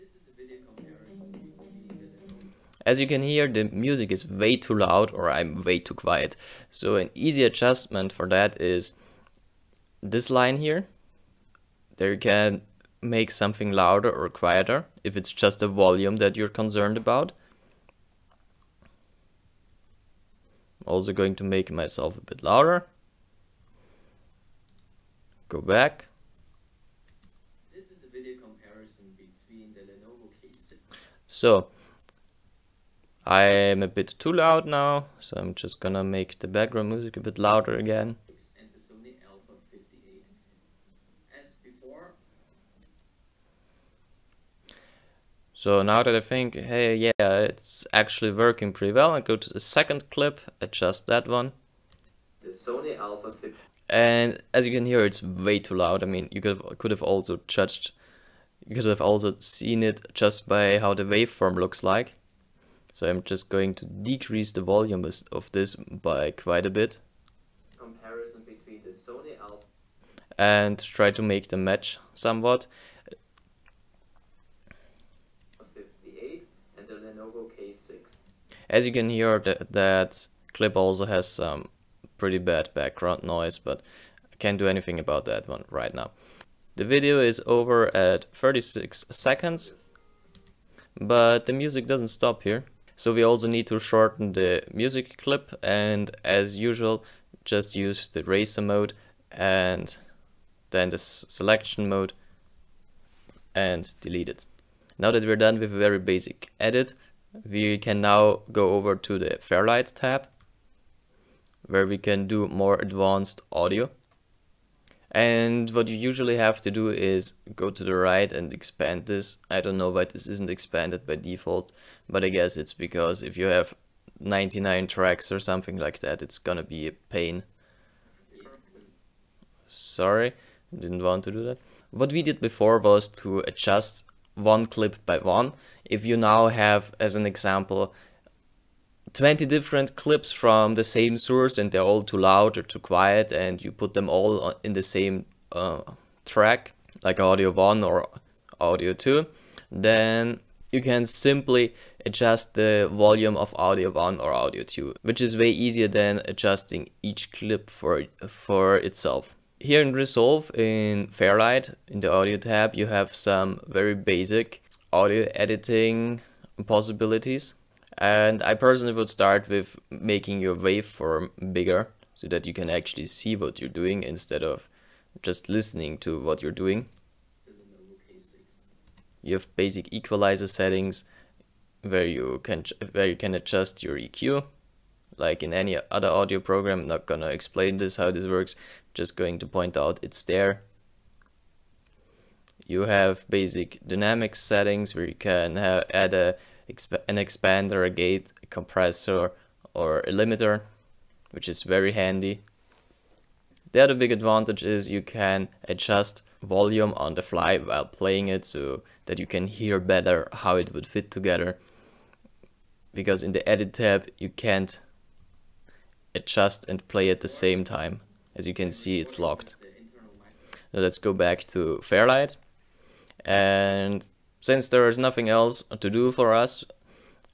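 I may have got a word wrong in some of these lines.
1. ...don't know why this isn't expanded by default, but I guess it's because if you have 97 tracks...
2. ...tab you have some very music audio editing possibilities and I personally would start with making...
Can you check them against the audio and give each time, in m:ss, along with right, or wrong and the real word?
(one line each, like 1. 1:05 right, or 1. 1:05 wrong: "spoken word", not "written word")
1. 1:59 wrong: "99", not "97"
2. 2:42 wrong: "basic", not "music".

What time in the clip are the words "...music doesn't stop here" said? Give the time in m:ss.
1:31.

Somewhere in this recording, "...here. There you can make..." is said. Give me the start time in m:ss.
0:10.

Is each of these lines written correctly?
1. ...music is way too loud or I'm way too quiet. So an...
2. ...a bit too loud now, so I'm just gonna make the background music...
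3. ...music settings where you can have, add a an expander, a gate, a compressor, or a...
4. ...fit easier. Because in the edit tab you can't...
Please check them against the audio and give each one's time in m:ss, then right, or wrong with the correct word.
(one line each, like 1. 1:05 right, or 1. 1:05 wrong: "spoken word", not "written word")
1. 0:03 right
2. 0:33 right
3. 3:13 wrong: "dynamic", not "music"
4. 3:30 wrong: "together", not "easier".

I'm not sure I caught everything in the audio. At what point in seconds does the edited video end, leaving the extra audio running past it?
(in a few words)
36 seconds.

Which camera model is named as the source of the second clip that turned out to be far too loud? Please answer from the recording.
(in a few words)
Sony Alpha 50.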